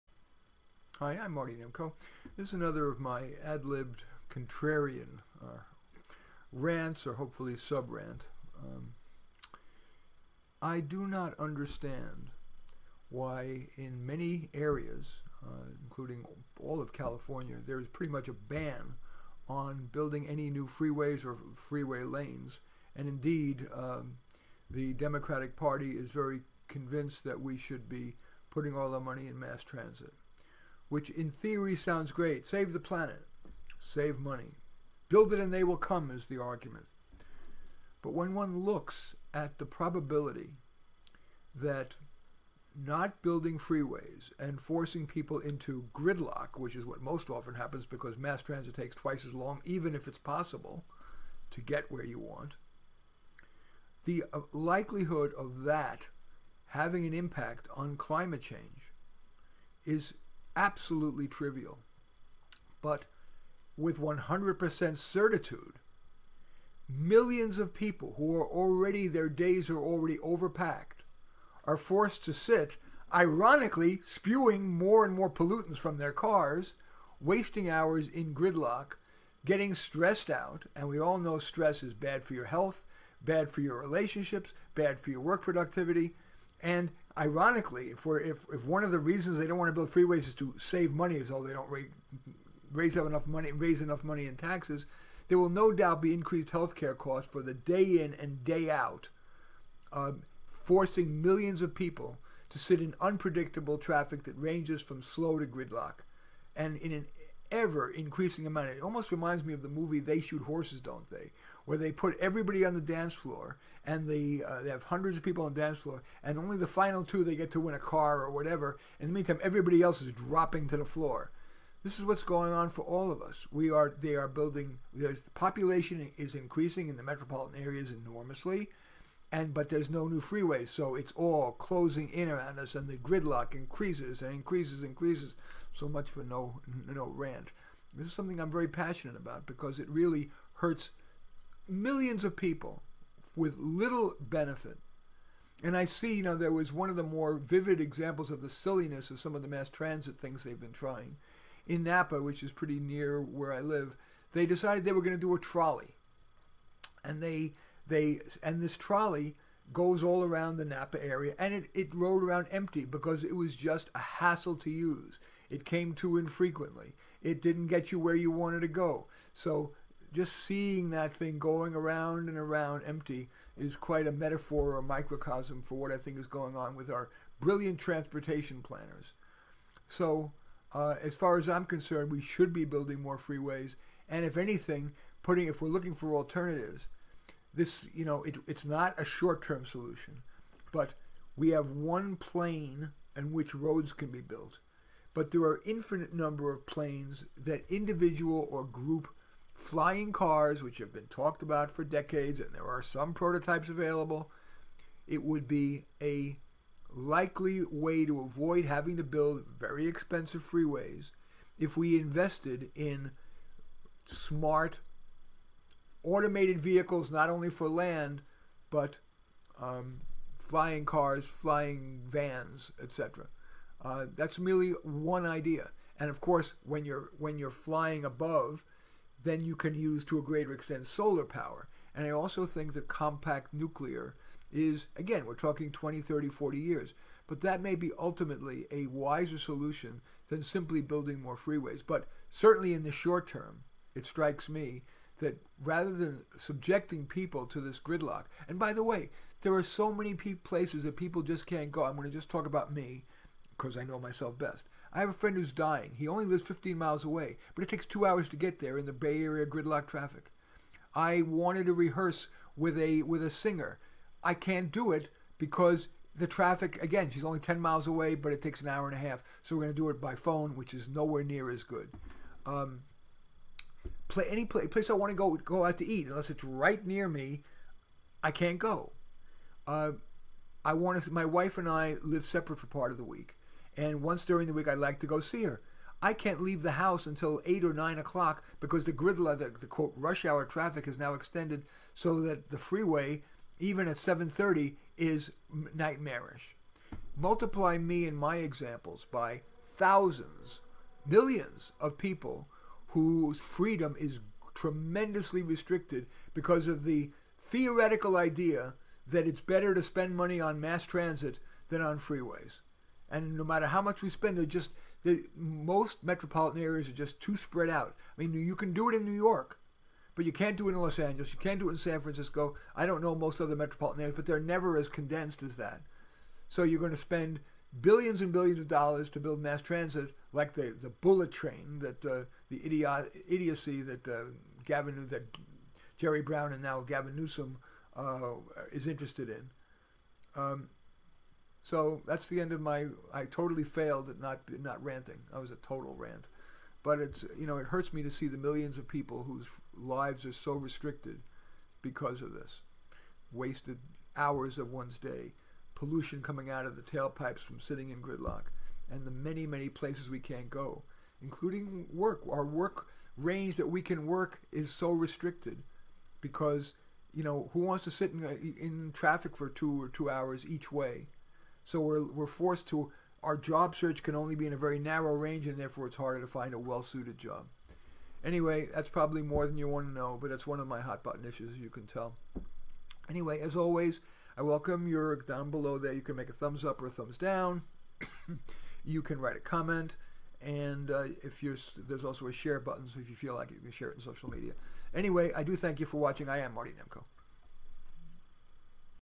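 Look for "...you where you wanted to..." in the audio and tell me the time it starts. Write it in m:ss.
2:47.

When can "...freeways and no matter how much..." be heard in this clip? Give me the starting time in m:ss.
5:11.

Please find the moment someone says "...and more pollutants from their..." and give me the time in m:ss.
1:15.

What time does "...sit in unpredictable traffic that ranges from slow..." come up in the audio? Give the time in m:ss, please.
1:42.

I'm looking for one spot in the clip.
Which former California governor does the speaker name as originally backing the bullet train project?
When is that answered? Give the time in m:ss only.
5:35.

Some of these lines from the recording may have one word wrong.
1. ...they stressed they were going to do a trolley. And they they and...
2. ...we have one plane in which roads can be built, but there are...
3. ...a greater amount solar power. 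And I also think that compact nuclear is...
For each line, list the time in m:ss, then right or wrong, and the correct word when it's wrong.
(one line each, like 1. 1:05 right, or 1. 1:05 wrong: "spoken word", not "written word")
1. 2:34 wrong: "decided", not "stressed"
2. 3:11 right
3. 3:50 wrong: "extent", not "amount".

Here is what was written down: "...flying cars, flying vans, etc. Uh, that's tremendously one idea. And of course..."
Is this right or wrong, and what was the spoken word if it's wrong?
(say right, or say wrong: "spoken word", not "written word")
wrong: "merely", not "tremendously".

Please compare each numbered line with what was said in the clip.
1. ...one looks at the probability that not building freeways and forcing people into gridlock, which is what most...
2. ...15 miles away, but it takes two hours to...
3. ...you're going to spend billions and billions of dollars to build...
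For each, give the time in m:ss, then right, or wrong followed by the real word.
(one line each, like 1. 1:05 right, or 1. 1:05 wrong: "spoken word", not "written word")
1. 0:38 right
2. 4:16 right
3. 5:26 right.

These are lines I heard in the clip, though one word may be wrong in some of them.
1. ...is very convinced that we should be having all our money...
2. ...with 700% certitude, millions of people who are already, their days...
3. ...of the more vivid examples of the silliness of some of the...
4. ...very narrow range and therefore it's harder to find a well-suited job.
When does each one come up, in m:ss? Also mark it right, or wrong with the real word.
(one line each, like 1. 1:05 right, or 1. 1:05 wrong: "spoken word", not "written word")
1. 0:25 wrong: "putting", not "having"
2. 1:03 wrong: "100", not "700"
3. 2:26 right
4. 6:14 right.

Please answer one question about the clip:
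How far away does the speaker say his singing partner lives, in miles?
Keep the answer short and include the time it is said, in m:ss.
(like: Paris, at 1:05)
10 miles, at 4:27.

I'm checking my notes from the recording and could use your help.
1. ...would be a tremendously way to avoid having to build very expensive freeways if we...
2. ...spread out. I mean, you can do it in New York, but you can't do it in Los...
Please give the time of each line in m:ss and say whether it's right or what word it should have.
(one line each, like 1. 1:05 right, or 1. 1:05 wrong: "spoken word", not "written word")
1. 3:25 wrong: "likely", not "tremendously"
2. 5:17 right.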